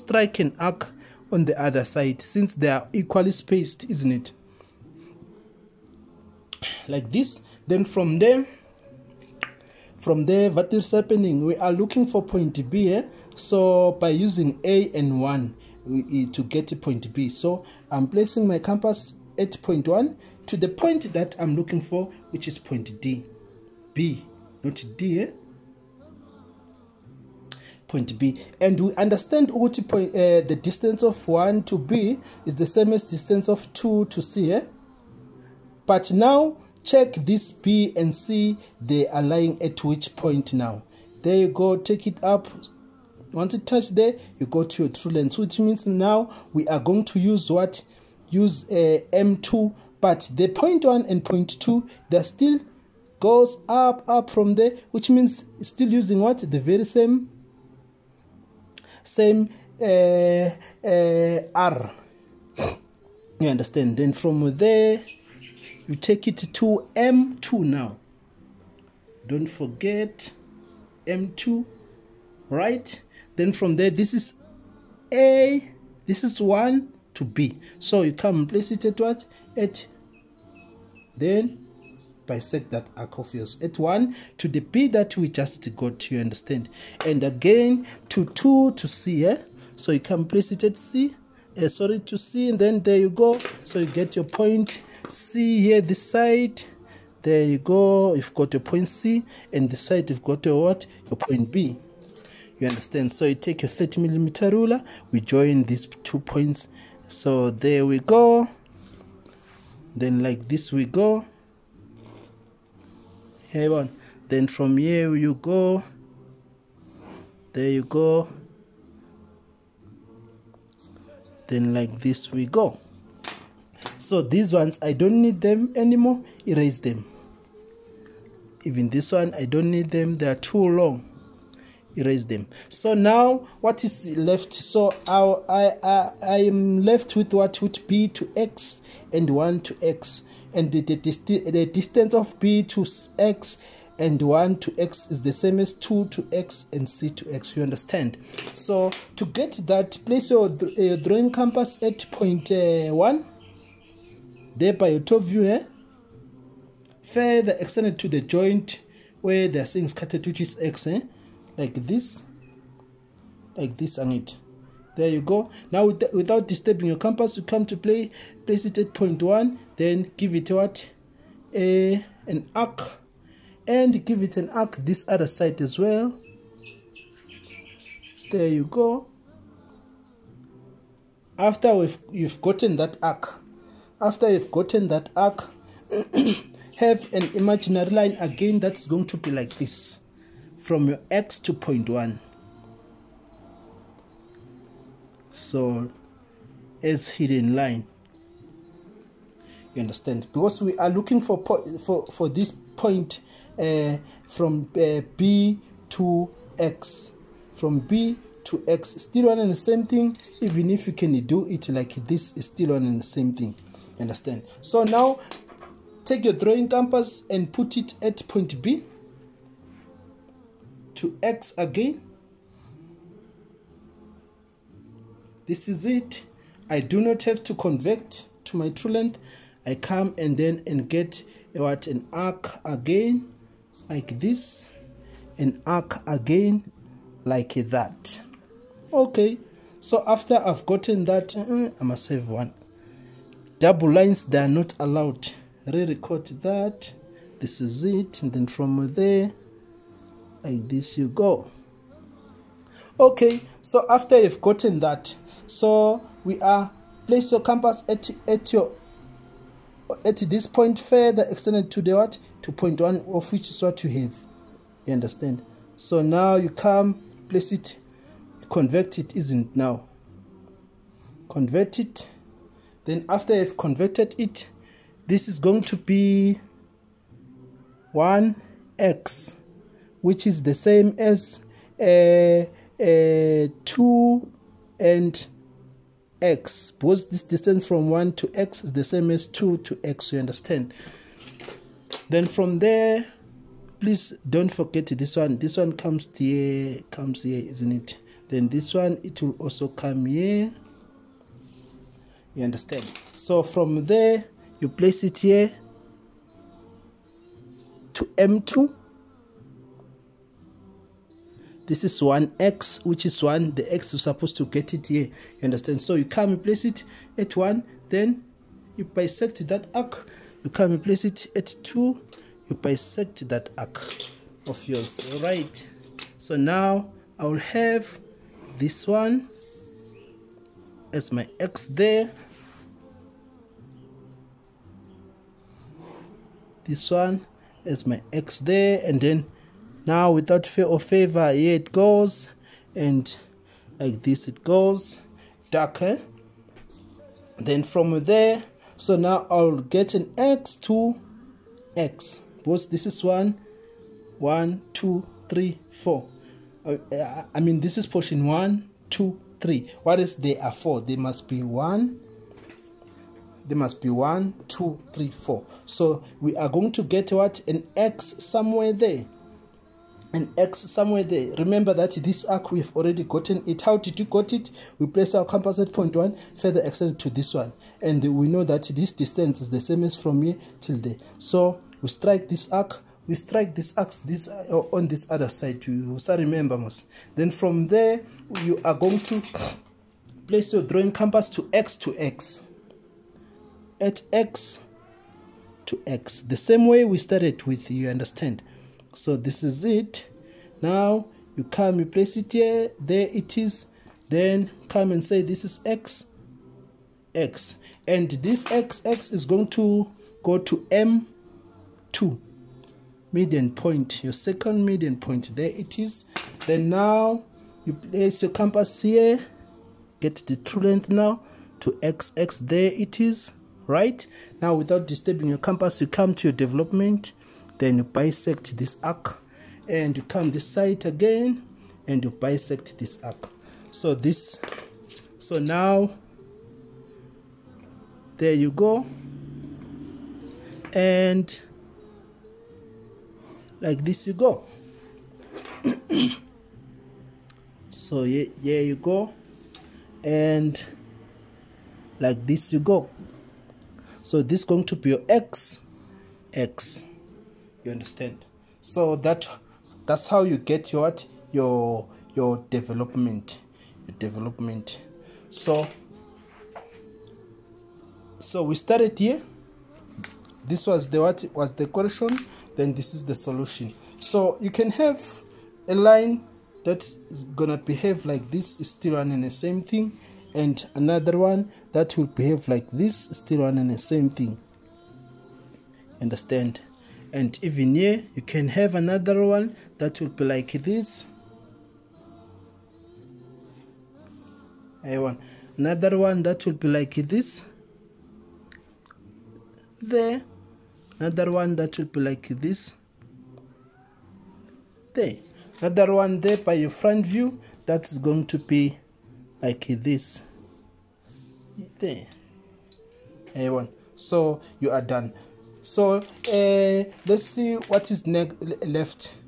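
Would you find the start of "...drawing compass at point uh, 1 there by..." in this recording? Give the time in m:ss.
2:30.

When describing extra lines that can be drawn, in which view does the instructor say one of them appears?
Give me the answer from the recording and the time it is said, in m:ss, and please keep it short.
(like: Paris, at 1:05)
front view, at 8:26.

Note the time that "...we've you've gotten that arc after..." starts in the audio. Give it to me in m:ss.
3:01.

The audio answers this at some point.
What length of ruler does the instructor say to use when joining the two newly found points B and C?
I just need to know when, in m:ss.
1:43.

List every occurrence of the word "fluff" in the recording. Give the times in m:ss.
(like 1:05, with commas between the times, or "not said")
not said.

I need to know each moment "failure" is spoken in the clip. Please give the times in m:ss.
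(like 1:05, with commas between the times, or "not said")
not said.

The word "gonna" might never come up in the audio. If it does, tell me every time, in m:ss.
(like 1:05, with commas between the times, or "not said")
7:57.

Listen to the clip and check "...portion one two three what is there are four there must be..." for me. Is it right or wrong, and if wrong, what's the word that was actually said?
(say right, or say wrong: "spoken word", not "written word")
right.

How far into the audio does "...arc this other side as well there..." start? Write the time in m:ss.
2:54.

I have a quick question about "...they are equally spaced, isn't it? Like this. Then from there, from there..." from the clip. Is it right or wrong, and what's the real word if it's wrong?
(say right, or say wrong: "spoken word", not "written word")
right.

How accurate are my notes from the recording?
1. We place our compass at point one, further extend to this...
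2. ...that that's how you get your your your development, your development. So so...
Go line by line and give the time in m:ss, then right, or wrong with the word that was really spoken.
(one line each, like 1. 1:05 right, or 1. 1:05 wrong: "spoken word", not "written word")
1. 6:14 right
2. 7:38 right.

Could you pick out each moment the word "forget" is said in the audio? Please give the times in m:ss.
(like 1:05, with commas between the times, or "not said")
1:09, 4:54.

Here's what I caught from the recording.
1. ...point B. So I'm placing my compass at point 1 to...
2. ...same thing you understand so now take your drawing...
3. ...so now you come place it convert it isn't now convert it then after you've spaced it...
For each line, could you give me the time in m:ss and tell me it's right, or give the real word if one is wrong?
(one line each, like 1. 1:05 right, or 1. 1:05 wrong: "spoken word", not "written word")
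1. 0:16 right
2. 3:33 right
3. 4:25 wrong: "converted", not "spaced".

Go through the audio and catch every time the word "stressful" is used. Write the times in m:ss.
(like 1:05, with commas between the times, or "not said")
not said.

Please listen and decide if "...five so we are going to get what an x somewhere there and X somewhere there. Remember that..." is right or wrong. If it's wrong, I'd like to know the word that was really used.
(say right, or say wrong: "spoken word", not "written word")
wrong: "four", not "five".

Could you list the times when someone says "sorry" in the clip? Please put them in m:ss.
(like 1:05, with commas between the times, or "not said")
1:31.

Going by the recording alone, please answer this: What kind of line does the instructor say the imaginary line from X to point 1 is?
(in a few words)
hidden line.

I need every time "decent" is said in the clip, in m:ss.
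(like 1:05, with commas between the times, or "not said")
not said.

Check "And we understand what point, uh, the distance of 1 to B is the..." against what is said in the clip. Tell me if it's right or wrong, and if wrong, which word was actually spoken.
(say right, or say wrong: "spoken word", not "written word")
right.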